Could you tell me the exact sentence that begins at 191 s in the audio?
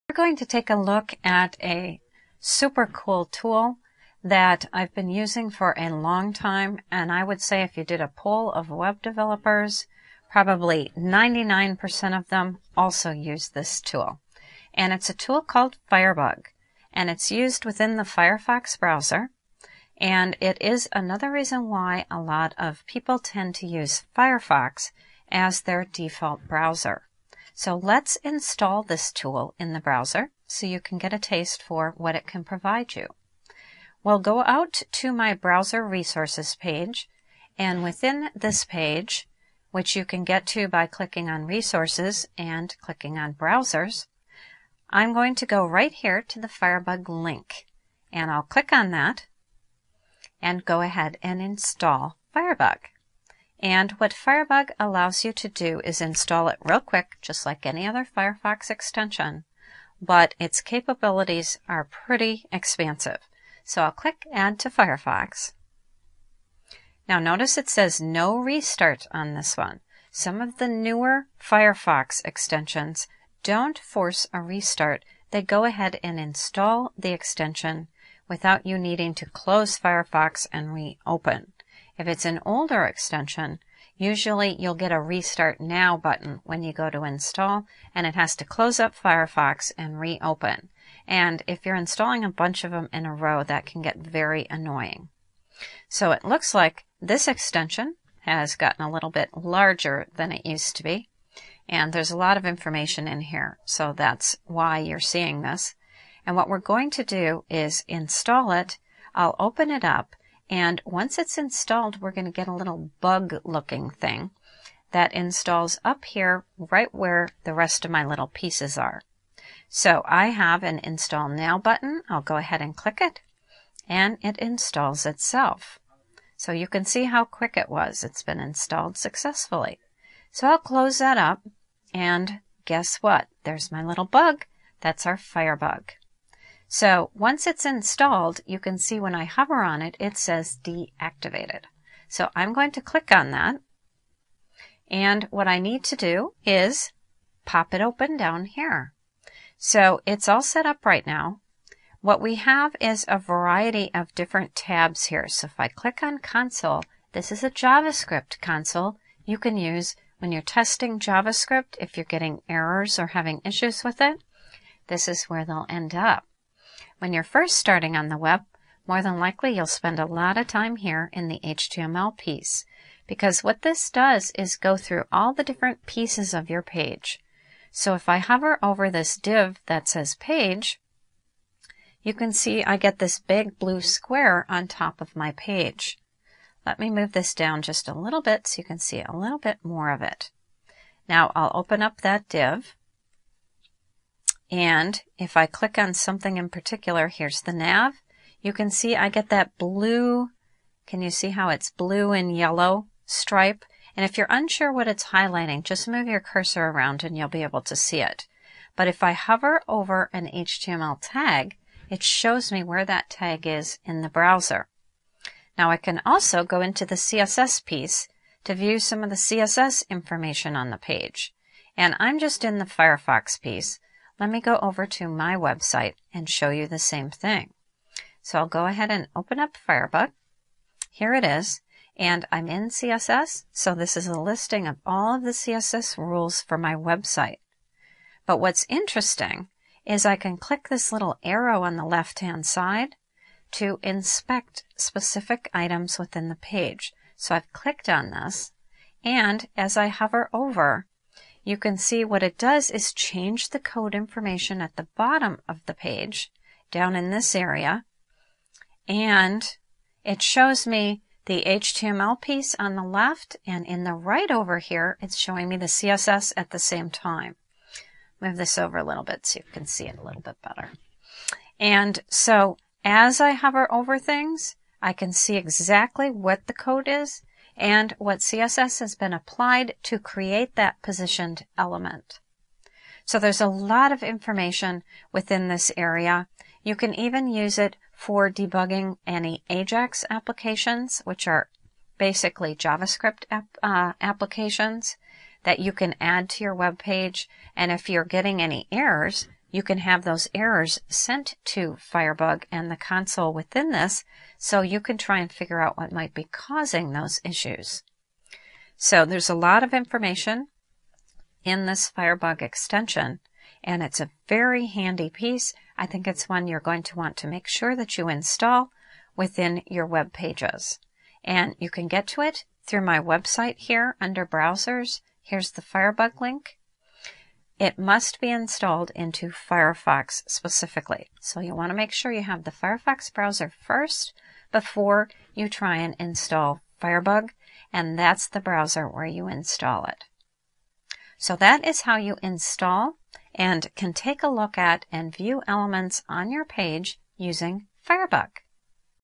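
Now I'll open up that div and if I click on something in particular, here's the nav.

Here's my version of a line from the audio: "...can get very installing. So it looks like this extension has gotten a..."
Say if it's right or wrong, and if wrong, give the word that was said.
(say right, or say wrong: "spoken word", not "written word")
wrong: "annoying", not "installing".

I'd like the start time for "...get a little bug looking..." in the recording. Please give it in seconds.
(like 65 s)
112 s.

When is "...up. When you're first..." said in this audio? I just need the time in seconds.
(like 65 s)
165 s.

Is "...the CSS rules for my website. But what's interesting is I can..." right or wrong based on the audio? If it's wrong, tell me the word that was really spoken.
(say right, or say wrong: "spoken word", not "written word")
right.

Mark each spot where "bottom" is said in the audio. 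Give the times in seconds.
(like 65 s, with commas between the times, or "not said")
254 s.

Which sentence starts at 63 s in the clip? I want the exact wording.
So I'll click Add to Firefox.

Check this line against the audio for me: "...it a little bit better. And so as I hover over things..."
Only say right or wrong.
right.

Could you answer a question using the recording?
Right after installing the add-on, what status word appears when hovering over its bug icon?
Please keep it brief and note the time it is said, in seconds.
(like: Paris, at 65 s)
deactivated, at 140 s.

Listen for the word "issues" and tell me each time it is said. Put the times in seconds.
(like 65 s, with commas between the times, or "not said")
163 s, 307 s.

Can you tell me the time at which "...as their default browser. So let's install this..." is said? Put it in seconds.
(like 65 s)
25 s.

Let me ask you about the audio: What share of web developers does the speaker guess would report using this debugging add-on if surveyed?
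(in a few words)
99%.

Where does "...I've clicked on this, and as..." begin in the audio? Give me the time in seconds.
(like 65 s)
247 s.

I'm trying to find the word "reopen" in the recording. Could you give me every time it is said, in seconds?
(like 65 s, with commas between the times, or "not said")
80 s, 89 s.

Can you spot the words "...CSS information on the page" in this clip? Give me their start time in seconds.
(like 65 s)
219 s.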